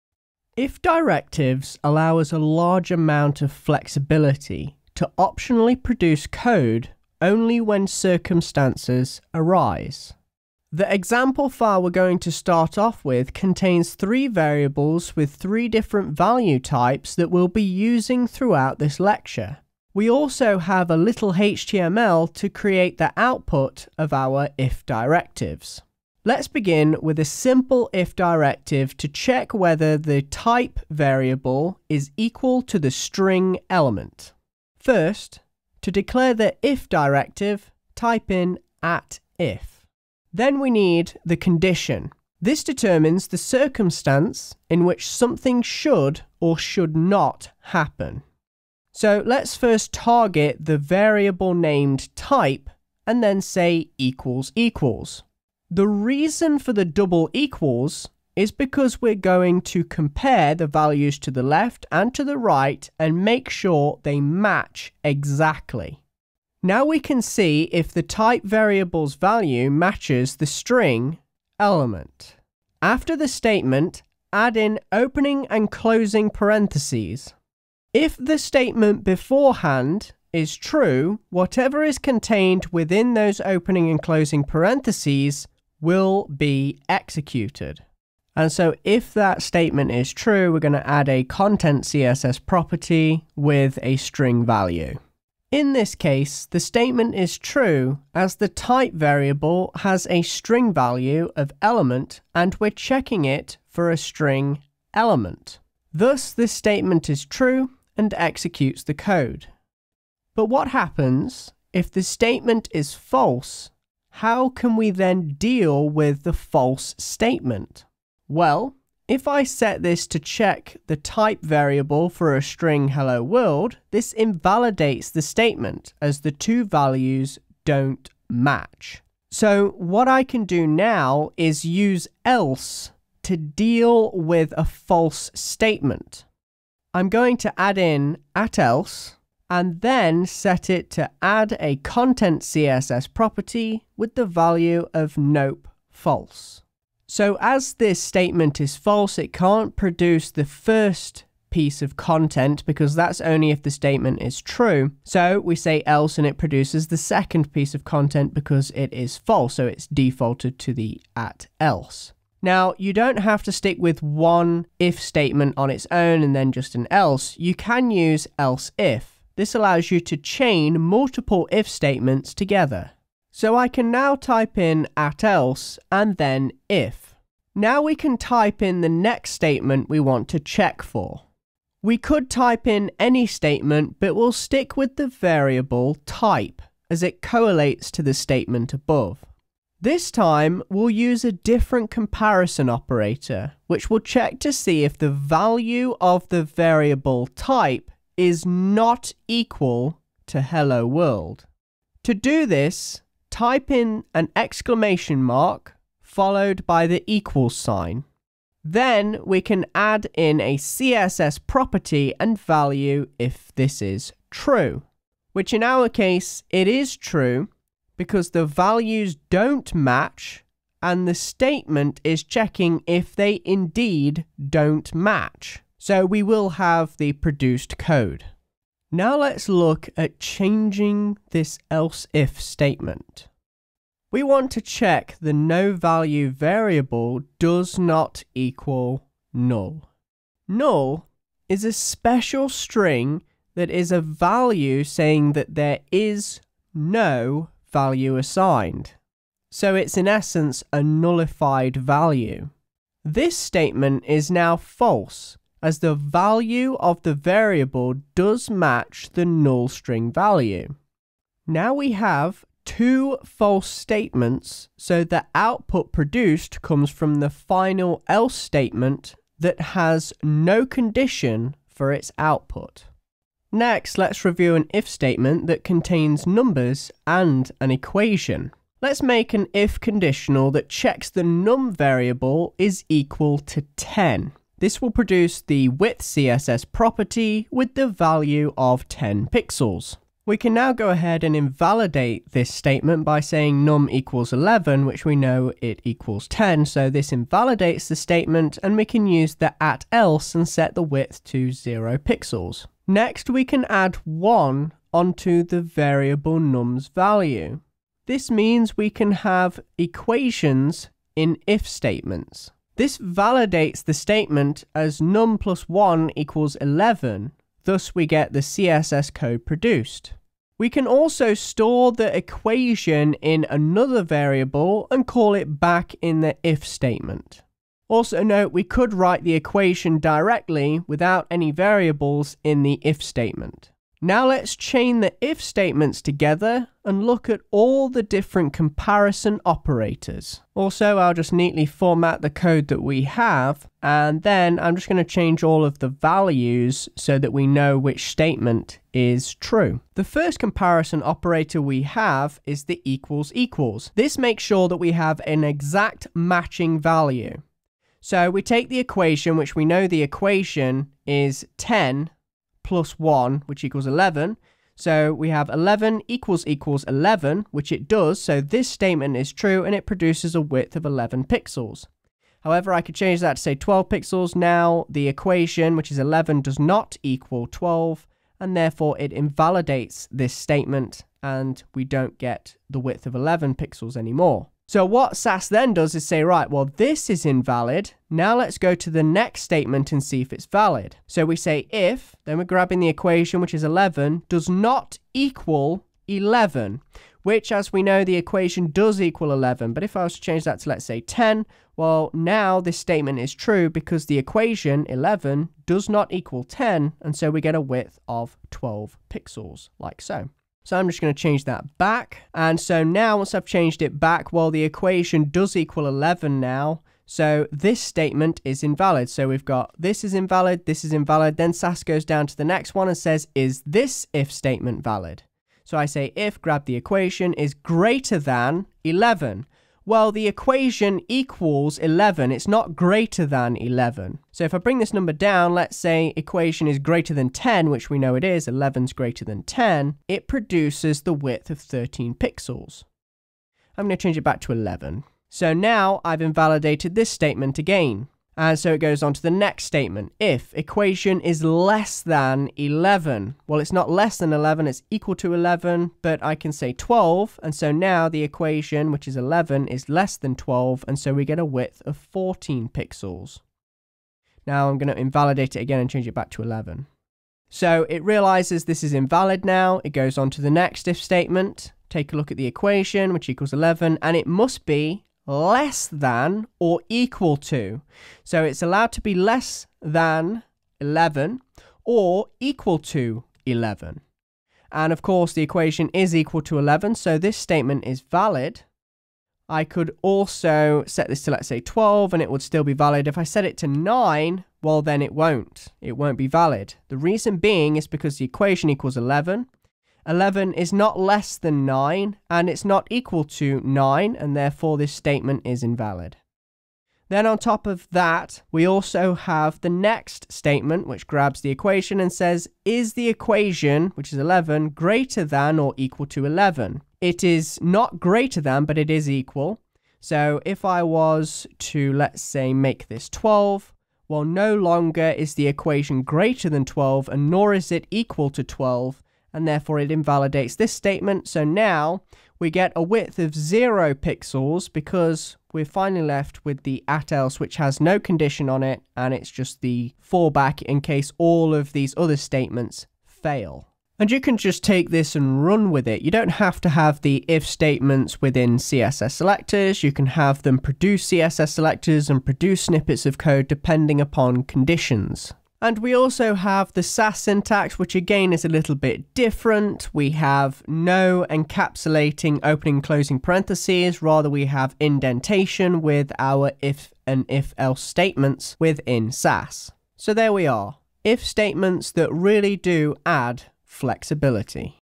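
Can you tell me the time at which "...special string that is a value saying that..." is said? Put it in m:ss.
4:01.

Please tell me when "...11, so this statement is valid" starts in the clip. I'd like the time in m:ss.
8:06.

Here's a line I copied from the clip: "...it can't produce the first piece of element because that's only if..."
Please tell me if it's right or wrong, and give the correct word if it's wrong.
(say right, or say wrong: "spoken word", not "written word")
wrong: "content", not "element".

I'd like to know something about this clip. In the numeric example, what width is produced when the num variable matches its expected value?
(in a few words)
10 pixels.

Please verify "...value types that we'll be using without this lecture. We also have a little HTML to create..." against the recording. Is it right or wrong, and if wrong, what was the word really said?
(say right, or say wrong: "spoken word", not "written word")
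wrong: "throughout", not "without".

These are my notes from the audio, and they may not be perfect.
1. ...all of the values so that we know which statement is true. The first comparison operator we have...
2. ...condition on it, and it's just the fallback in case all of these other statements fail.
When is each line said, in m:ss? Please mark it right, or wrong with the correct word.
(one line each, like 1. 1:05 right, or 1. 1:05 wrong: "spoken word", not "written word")
1. 5:45 right
2. 8:57 right.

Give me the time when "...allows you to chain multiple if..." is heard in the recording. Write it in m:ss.
2:49.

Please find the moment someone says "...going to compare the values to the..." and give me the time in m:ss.
0:59.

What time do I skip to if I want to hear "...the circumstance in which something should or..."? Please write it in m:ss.
0:43.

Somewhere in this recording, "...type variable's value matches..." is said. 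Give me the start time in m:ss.
1:08.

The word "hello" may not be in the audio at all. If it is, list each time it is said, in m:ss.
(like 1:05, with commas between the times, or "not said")
2:02, 3:20.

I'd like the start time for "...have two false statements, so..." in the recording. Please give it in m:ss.
4:21.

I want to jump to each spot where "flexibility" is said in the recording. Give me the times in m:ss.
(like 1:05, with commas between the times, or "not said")
0:03, 9:33.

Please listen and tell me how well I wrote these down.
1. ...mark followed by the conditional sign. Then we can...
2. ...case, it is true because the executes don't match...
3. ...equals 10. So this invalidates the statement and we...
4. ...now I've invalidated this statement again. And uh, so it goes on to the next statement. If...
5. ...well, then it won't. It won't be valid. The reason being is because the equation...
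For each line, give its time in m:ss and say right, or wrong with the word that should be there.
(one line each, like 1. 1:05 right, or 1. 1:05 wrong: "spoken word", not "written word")
1. 3:25 wrong: "equal", not "conditional"
2. 3:35 wrong: "values", not "executes"
3. 4:55 right
4. 7:25 right
5. 8:14 right.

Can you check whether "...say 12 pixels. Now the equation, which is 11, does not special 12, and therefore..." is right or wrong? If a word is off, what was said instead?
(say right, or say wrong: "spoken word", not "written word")
wrong: "equal", not "special".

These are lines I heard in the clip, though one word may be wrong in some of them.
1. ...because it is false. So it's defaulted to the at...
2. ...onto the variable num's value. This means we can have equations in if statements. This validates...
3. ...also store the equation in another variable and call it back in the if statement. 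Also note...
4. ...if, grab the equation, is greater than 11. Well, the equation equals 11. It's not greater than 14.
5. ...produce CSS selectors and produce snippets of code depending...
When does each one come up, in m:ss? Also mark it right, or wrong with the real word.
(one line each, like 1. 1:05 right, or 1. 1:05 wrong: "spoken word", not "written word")
1. 2:38 right
2. 5:04 right
3. 5:20 right
4. 7:06 wrong: "11", not "14"
5. 9:10 right.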